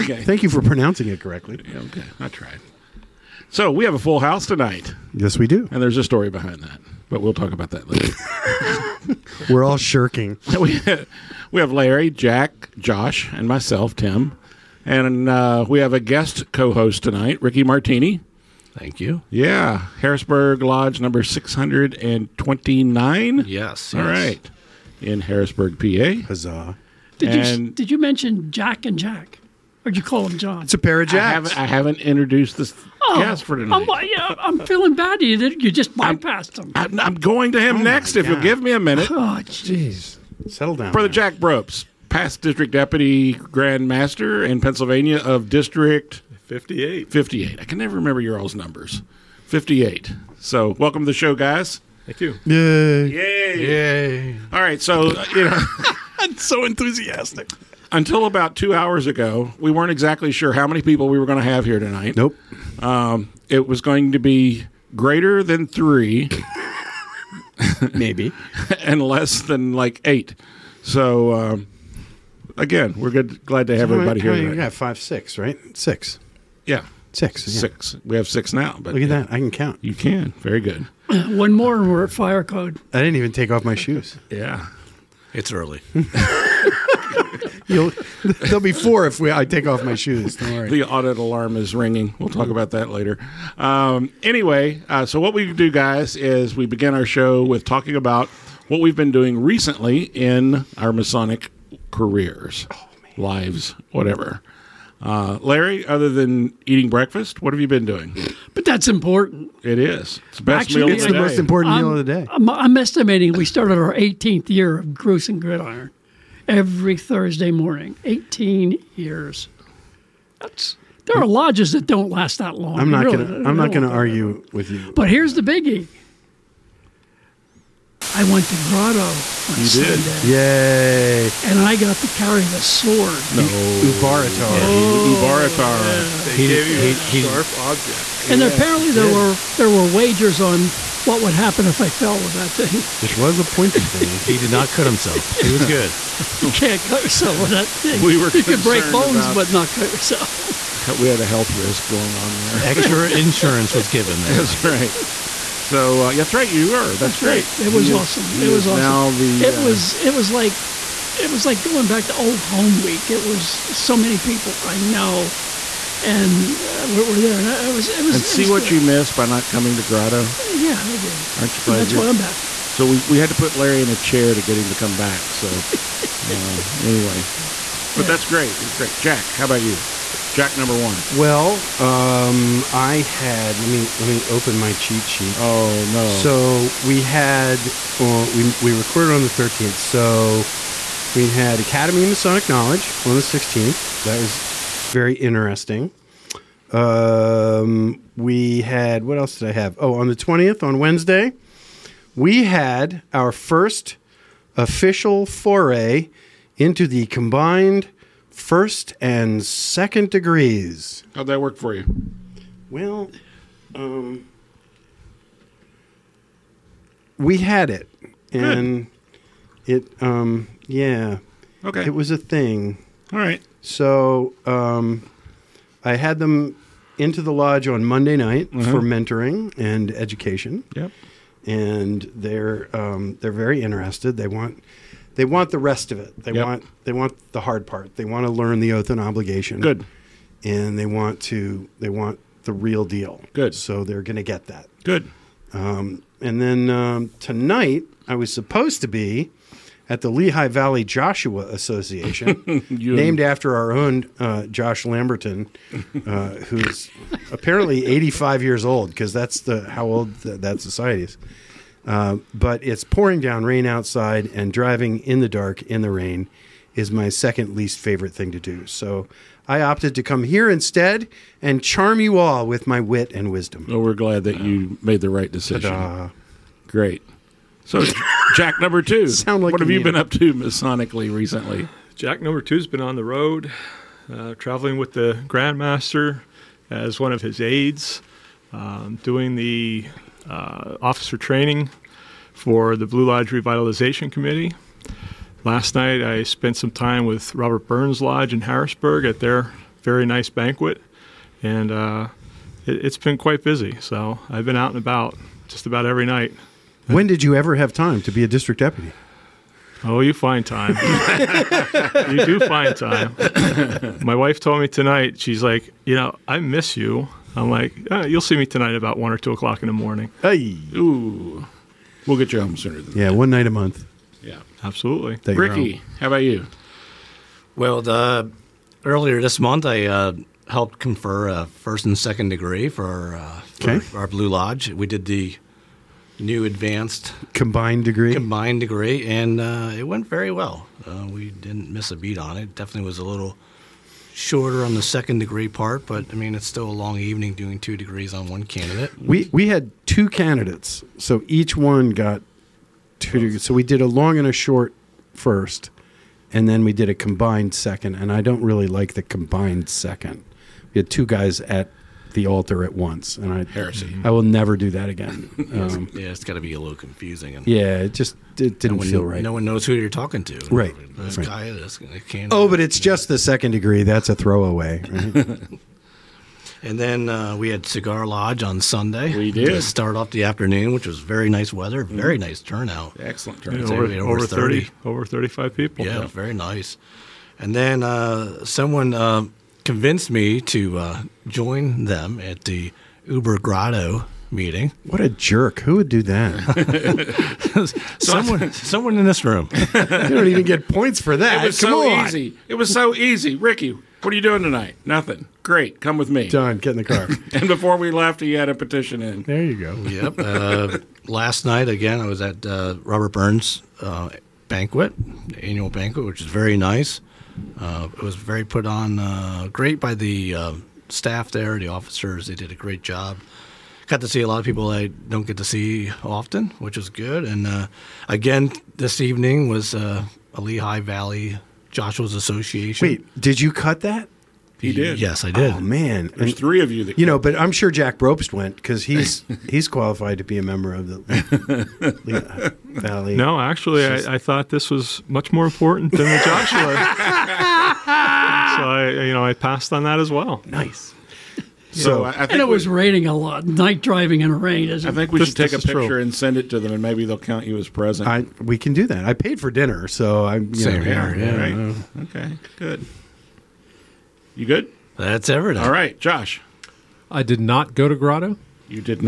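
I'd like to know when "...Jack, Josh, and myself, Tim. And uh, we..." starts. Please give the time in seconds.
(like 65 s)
12 s.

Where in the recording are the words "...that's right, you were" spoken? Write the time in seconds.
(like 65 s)
156 s.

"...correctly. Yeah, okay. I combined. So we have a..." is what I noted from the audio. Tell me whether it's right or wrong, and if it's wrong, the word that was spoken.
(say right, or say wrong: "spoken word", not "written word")
wrong: "tried", not "combined".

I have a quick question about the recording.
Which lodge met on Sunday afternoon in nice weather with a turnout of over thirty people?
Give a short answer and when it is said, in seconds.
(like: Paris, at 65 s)
Cigar Lodge, at 377 s.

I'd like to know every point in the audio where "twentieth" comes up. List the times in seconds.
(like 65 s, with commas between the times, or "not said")
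200 s.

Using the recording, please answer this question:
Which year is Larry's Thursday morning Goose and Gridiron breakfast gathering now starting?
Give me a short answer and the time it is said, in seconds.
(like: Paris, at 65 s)
18th, at 113 s.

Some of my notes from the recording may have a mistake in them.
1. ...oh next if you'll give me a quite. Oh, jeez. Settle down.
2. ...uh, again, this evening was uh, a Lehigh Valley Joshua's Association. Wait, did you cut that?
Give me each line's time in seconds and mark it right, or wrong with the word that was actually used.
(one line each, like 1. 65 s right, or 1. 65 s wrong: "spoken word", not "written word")
1. 37 s wrong: "minute", not "quite"
2. 427 s right.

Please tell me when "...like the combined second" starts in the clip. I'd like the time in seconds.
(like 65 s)
358 s.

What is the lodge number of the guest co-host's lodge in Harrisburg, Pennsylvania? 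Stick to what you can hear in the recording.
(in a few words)
629.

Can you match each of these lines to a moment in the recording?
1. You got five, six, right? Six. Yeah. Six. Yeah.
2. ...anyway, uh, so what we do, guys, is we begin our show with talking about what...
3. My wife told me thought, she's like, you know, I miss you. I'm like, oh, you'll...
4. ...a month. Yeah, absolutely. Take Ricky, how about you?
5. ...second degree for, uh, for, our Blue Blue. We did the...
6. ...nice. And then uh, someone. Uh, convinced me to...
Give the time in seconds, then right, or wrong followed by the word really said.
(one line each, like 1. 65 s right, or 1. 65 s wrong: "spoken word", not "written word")
1. 74 s right
2. 94 s right
3. 314 s wrong: "tonight", not "thought"
4. 323 s right
5. 331 s wrong: "Lodge", not "Blue"
6. 386 s right.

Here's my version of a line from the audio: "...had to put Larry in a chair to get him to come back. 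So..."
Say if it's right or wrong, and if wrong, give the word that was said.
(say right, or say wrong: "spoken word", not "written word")
right.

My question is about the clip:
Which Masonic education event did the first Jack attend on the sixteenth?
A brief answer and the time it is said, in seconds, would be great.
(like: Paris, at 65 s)
Academy of Masonic Knowledge, at 191 s.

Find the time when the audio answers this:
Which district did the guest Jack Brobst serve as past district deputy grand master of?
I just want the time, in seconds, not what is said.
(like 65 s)
45 s.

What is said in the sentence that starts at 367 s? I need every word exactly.
And yeah, it just it didn't no one, feel right.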